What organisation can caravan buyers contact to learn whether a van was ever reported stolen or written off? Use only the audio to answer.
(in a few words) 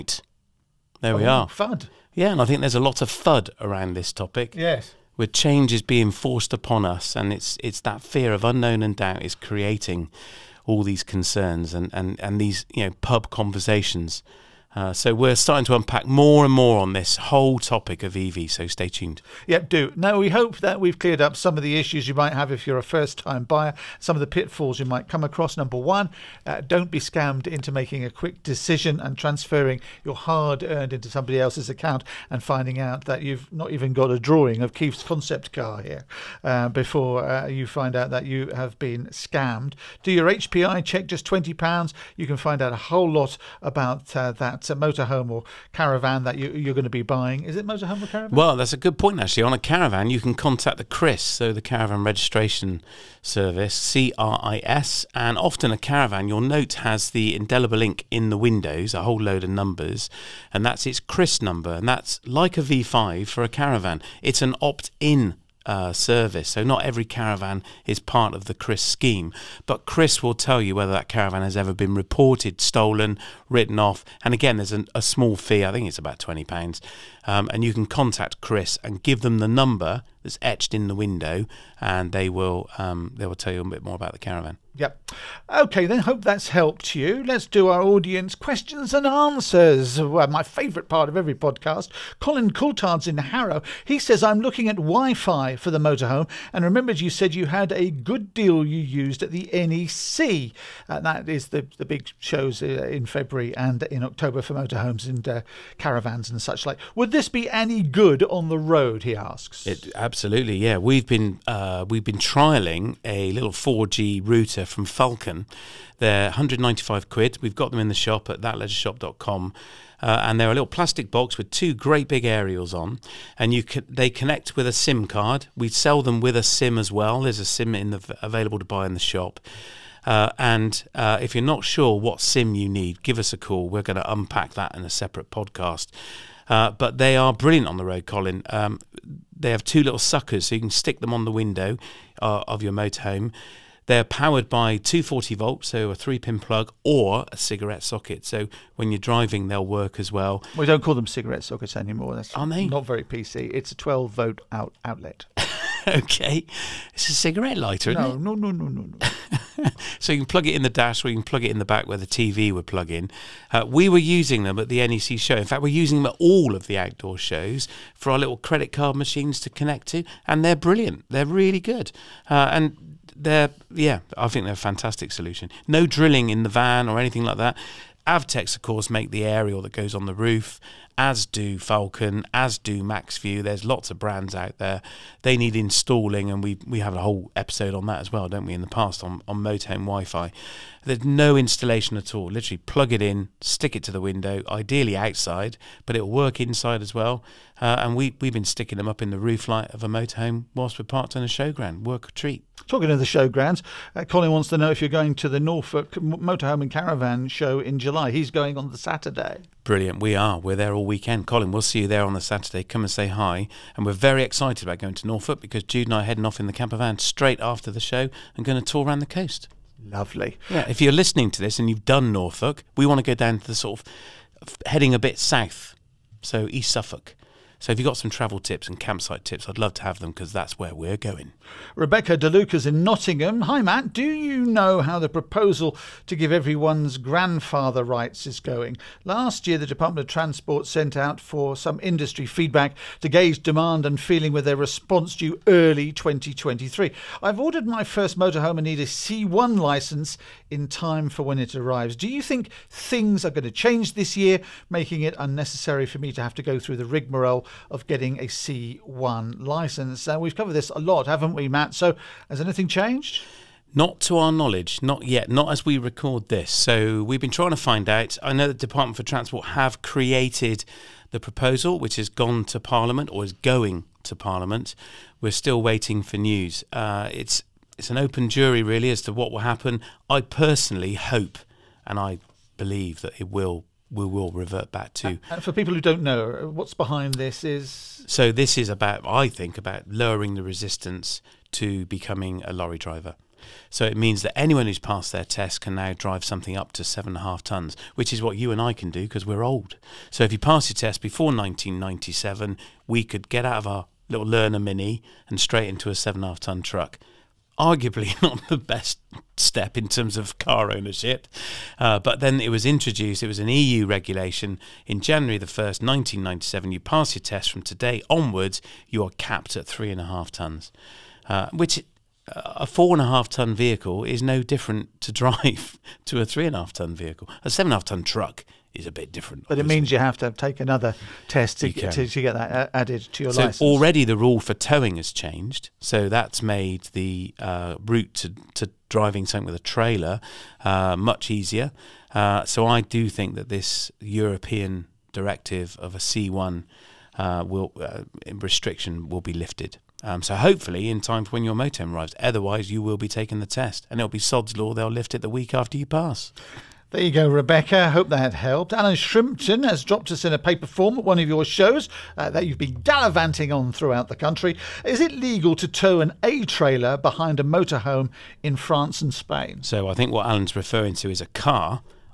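Caravan Registration Service.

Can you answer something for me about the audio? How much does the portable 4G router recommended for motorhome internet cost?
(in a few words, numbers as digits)
£195.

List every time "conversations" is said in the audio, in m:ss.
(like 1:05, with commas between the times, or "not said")
0:13.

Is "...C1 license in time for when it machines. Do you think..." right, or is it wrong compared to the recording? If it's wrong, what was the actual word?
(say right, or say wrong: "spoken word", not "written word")
wrong: "arrives", not "machines".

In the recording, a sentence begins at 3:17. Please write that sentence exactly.
Uh, and we, we've been sticking them up in the roof light of a motorhome whilst we're parked on a showground.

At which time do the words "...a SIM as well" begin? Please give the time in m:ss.
2:06.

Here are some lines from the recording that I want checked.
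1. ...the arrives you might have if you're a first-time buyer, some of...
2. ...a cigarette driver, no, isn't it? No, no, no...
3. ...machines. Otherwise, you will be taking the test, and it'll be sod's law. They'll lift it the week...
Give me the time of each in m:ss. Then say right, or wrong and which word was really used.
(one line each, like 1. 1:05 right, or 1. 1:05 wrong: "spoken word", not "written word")
1. 0:21 wrong: "issues", not "arrives"
2. 2:37 wrong: "lighter", not "driver"
3. 5:51 wrong: "arrives", not "machines".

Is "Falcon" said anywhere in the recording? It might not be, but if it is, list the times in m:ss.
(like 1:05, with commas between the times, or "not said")
1:54, 3:01.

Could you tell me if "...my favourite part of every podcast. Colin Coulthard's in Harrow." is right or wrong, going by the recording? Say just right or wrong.
right.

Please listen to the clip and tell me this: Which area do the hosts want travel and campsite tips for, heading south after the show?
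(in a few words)
East Suffolk.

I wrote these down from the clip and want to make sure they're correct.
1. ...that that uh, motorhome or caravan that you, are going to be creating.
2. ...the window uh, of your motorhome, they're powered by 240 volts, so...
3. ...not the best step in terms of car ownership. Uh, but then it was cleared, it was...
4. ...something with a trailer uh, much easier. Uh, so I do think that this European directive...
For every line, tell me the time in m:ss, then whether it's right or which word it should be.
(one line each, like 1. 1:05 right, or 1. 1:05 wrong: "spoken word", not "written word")
1. 0:44 wrong: "buying", not "creating"
2. 2:21 right
3. 5:08 wrong: "introduced", not "cleared"
4. 5:39 right.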